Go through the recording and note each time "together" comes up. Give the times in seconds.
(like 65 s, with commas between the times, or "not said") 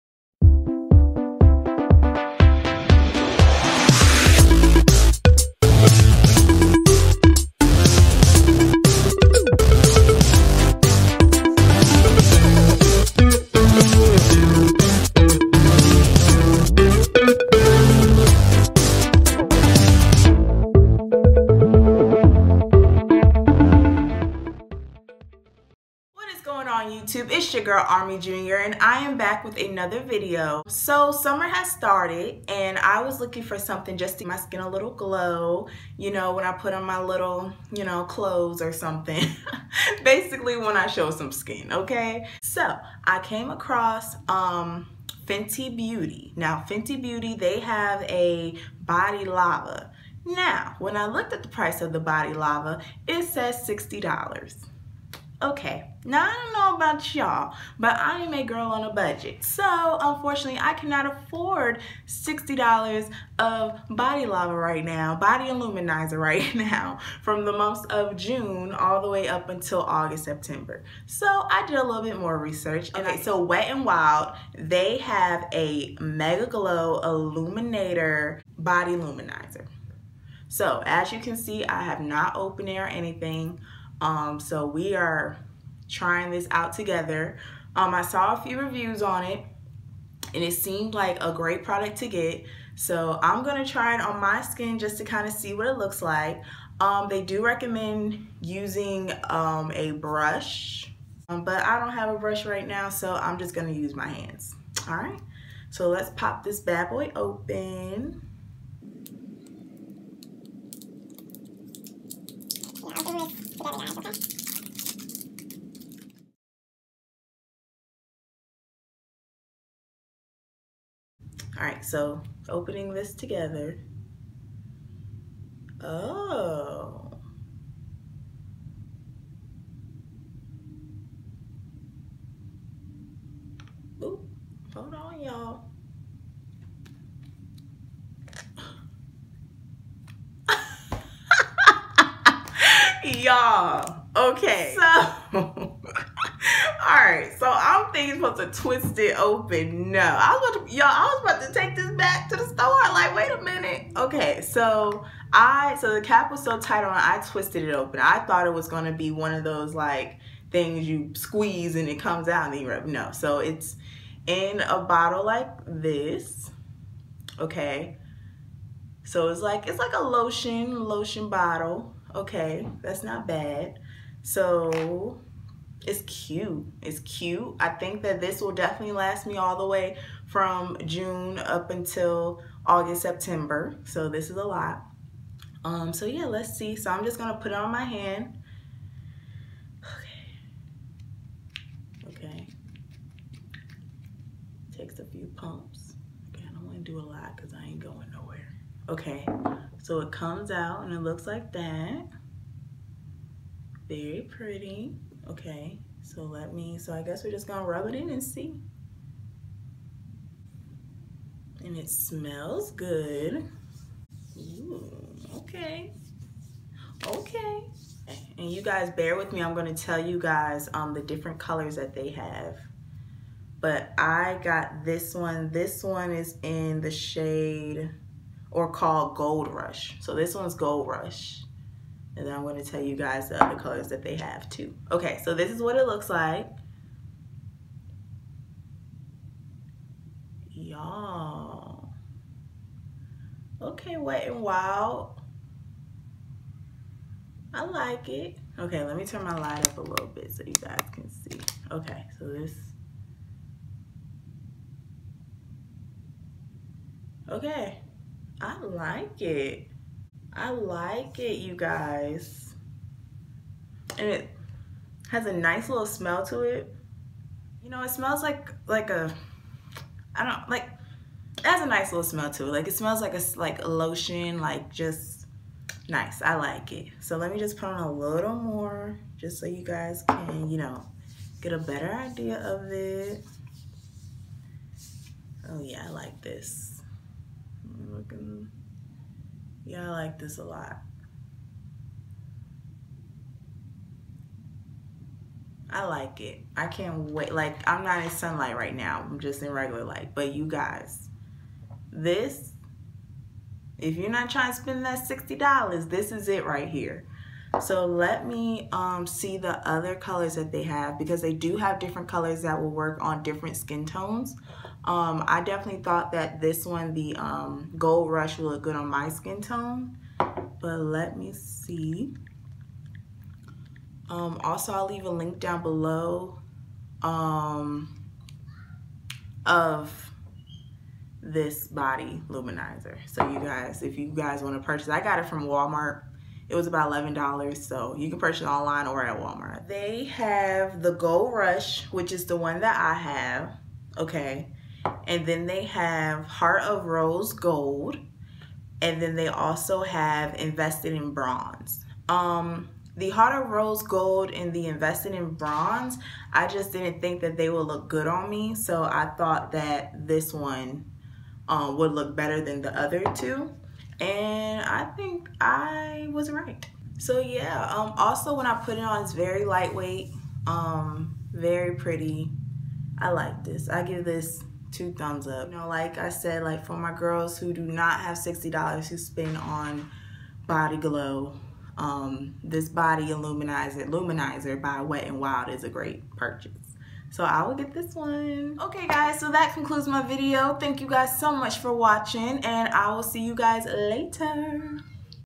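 86 s, 123 s.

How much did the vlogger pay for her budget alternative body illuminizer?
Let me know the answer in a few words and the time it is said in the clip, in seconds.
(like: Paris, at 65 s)
$11, at 336 s.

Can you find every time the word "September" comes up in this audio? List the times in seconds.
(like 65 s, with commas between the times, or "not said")
70 s, 183 s.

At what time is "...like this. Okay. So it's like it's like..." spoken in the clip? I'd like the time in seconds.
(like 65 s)
165 s.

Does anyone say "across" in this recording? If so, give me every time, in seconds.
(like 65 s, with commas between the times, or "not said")
43 s.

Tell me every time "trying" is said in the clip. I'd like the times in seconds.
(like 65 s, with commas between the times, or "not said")
85 s, 304 s.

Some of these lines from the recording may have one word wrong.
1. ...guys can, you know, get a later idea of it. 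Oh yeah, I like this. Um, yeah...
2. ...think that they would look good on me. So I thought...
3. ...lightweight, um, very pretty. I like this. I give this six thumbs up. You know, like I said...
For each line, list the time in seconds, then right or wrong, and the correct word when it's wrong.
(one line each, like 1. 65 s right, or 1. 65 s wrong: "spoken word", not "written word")
1. 279 s wrong: "better", not "later"
2. 357 s right
3. 369 s wrong: "two", not "six".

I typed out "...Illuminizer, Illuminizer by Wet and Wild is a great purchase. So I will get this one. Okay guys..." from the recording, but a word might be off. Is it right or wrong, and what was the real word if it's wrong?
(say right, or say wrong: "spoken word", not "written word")
right.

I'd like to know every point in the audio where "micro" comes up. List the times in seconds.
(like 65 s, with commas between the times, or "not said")
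not said.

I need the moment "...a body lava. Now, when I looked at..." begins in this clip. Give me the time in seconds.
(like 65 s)
48 s.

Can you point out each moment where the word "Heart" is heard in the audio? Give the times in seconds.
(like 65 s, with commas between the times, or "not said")
346 s, 353 s.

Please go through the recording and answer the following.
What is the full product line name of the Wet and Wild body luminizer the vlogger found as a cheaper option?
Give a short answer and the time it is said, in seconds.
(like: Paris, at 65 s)
Mega Glow, at 75 s.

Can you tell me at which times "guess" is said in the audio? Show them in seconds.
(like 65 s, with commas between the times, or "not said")
207 s.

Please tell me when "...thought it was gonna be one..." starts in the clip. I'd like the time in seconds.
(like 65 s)
158 s.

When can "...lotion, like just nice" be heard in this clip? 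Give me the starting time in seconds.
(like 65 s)
273 s.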